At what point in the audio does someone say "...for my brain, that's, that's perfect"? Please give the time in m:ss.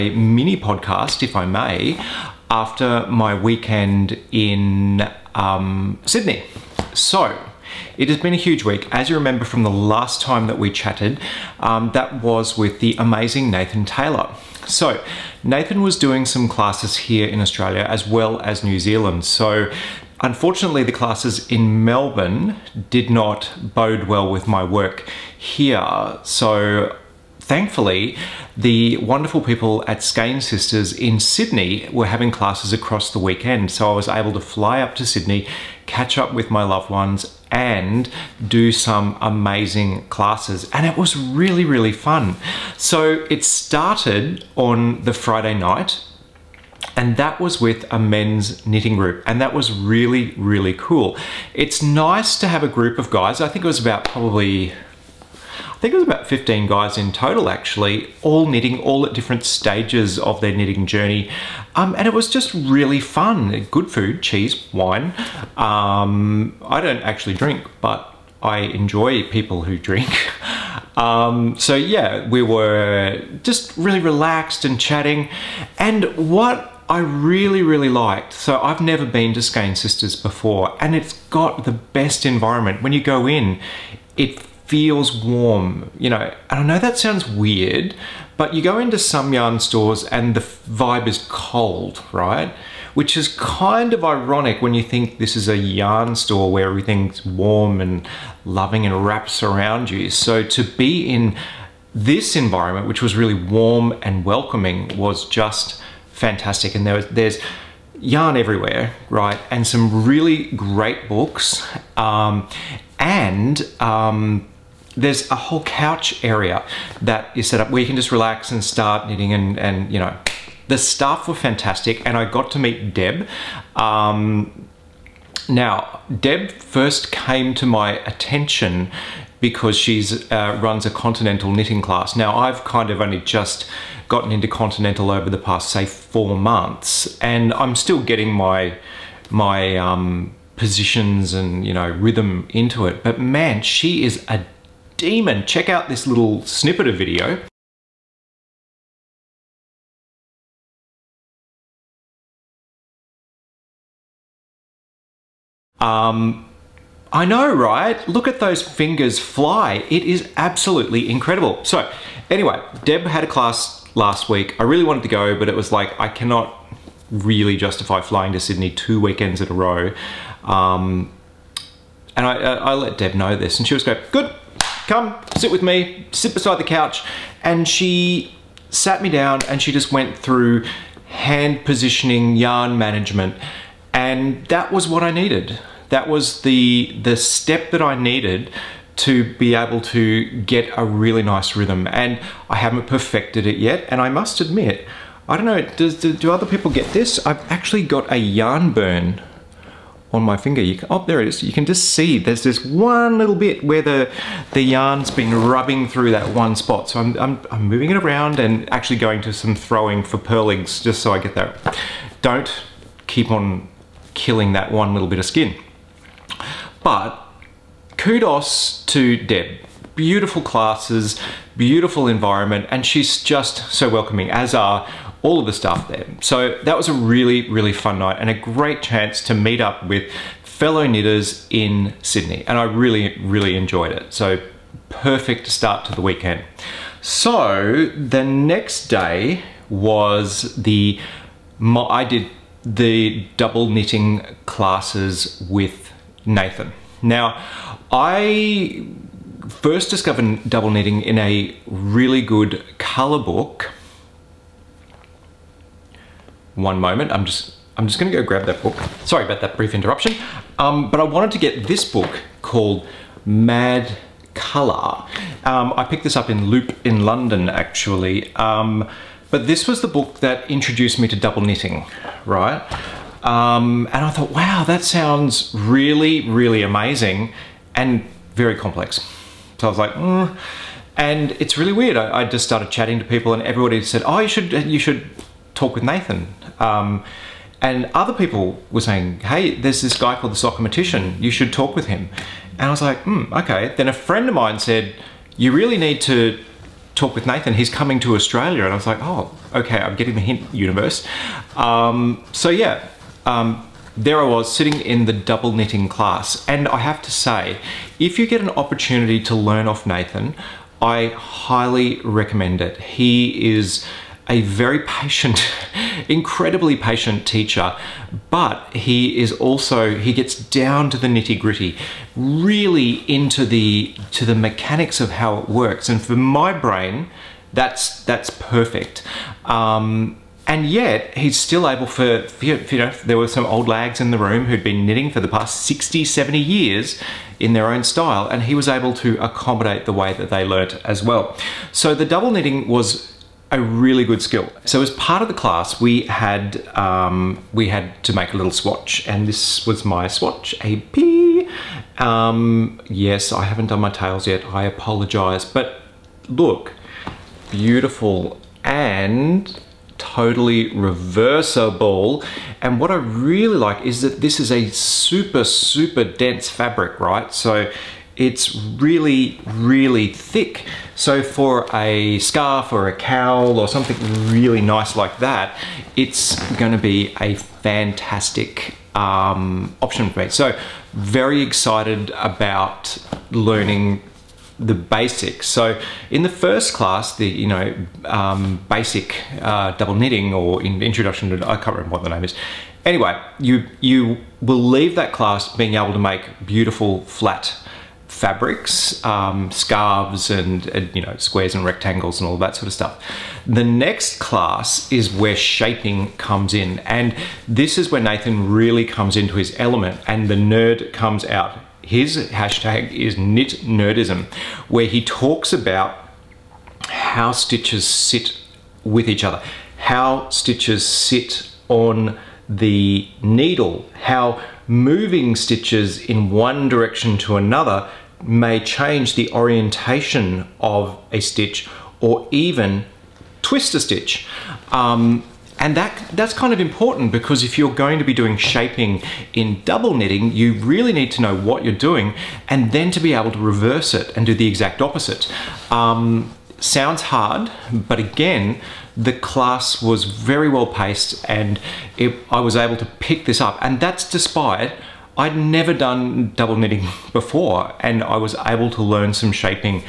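5:26.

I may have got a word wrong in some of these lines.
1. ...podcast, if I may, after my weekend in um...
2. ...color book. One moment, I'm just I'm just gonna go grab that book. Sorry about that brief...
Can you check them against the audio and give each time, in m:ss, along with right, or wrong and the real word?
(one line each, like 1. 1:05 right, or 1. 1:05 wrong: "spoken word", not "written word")
1. 0:00 right
2. 4:12 right.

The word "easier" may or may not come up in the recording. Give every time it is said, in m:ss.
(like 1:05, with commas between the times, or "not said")
not said.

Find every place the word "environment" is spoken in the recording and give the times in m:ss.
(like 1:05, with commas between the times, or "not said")
1:22, 1:42, 3:42.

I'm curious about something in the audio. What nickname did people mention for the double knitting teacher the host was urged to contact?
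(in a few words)
the Sockmatician.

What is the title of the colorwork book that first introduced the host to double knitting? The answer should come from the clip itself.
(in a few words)
Mad Color.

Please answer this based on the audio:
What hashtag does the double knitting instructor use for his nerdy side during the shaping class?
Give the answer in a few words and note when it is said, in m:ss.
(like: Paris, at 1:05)
knit nerdism, at 6:53.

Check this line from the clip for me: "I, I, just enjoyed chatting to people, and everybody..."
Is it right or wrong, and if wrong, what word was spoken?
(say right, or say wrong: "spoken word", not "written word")
wrong: "started", not "enjoyed".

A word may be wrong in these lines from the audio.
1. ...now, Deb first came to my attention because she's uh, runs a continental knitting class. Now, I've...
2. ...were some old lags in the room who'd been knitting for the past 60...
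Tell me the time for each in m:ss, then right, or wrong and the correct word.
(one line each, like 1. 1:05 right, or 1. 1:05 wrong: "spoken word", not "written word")
1. 2:05 right
2. 5:33 right.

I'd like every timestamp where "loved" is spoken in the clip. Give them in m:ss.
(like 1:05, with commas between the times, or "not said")
0:36.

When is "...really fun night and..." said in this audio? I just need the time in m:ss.
3:47.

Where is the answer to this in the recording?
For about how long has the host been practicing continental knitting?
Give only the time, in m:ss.
2:15.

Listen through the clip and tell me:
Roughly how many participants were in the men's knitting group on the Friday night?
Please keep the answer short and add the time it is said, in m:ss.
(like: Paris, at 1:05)
15, at 0:56.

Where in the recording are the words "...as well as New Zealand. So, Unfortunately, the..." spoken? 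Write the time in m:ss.
0:17.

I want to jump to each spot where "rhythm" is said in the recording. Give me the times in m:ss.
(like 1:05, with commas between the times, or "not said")
2:21, 3:11.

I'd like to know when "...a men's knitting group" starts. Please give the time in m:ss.
0:47.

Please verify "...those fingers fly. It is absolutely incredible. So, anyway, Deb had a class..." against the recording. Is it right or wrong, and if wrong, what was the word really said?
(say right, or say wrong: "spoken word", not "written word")
right.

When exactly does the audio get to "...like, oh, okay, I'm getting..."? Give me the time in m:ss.
4:58.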